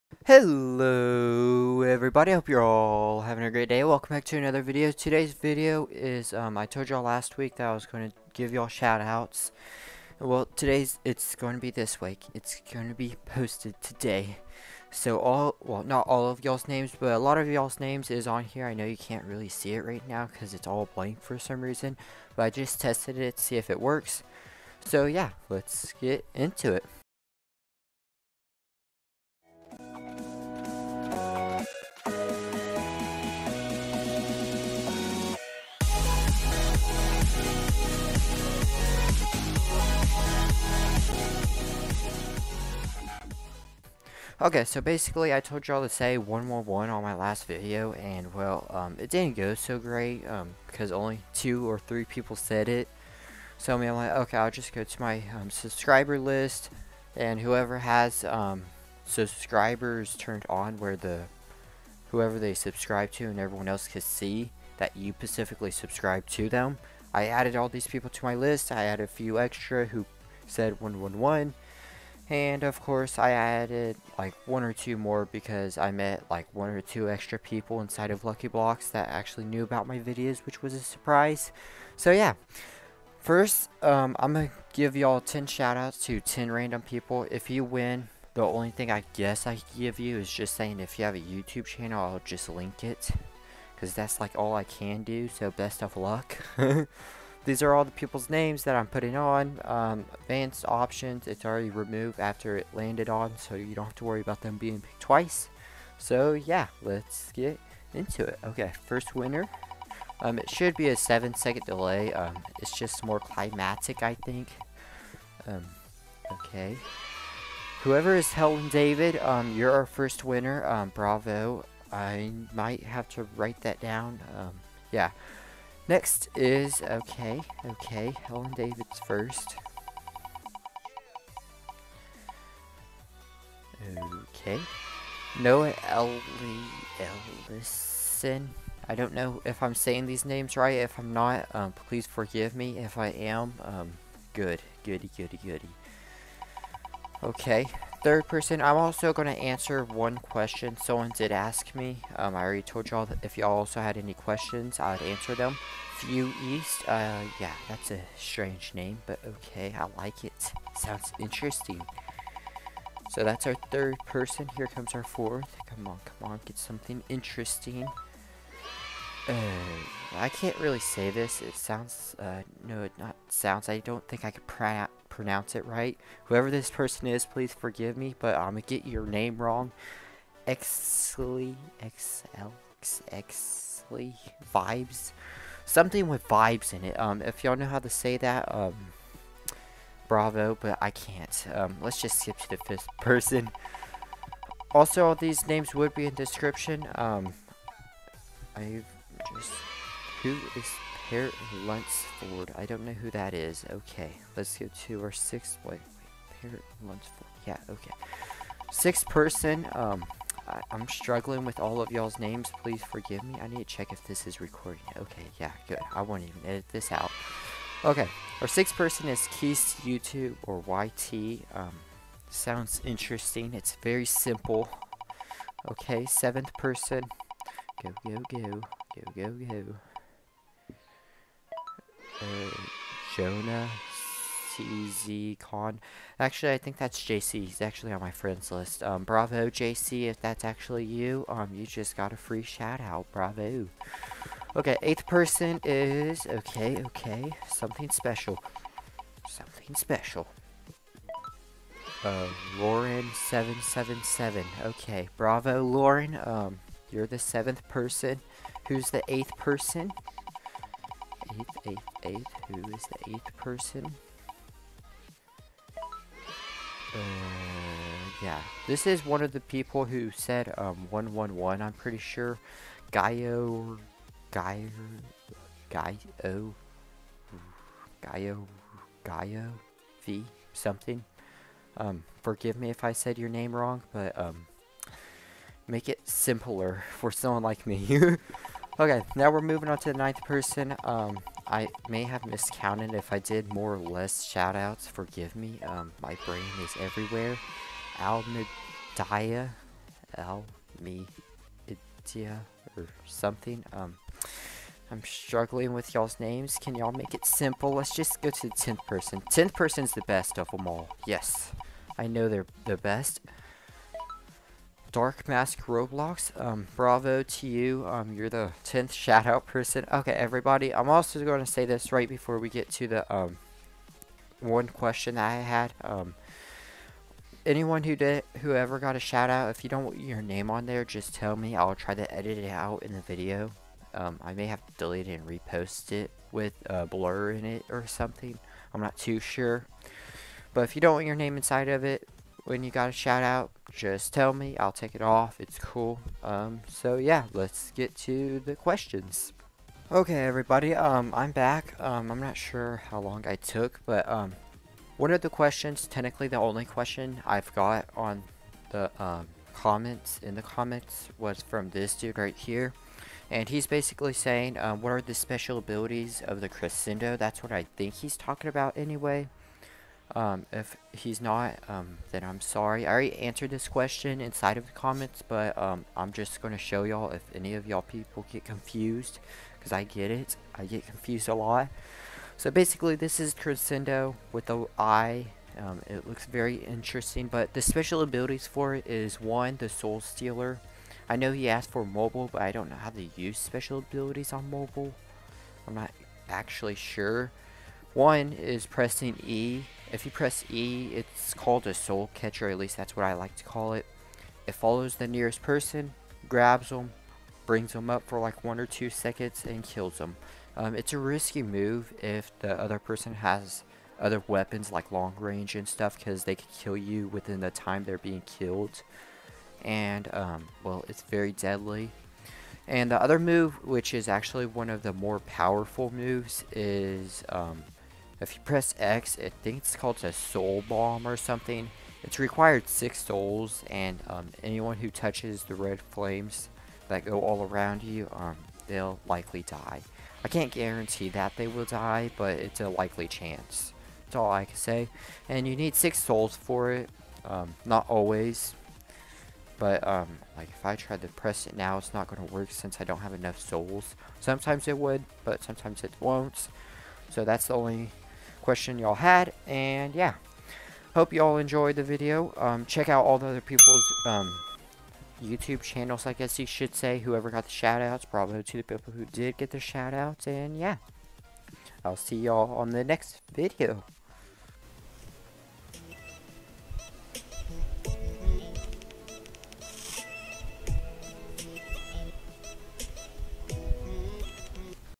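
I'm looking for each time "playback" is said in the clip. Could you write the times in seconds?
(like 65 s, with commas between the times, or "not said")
not said.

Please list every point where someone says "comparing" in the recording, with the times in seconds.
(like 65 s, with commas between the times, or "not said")
not said.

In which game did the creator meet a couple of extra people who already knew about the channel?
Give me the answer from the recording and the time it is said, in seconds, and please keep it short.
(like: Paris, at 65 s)
Lucky Blocks, at 78 s.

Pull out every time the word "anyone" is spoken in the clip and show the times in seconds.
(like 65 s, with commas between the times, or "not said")
327 s, 434 s.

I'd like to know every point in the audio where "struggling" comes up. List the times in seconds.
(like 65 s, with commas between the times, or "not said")
210 s, 305 s.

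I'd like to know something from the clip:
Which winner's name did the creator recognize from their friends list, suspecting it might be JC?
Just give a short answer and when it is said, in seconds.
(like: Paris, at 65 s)
Jonah CZ Con, at 233 s.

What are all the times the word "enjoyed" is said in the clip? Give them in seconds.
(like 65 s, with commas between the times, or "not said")
461 s.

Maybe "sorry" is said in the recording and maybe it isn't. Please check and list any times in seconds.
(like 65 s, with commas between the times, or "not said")
372 s.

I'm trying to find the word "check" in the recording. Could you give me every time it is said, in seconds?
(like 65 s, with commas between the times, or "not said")
213 s, 462 s.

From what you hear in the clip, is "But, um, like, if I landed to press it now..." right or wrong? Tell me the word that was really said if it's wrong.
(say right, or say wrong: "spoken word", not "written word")
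wrong: "tried", not "landed".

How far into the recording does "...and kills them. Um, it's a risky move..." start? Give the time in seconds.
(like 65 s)
409 s.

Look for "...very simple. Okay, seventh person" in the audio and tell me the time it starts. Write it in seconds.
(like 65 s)
223 s.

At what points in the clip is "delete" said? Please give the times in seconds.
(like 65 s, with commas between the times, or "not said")
334 s.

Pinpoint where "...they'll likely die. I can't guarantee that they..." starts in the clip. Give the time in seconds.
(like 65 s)
438 s.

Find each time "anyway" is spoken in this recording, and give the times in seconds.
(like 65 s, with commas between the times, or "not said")
368 s.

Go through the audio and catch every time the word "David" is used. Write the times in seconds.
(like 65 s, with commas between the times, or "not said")
118 s, 128 s.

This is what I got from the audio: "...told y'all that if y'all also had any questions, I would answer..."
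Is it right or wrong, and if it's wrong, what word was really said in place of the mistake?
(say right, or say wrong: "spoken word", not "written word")
right.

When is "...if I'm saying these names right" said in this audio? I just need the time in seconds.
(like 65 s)
139 s.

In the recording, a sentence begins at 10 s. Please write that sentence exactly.
Well, today's, it's going to be this week.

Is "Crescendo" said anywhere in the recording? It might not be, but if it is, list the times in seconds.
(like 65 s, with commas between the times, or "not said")
366 s, 383 s.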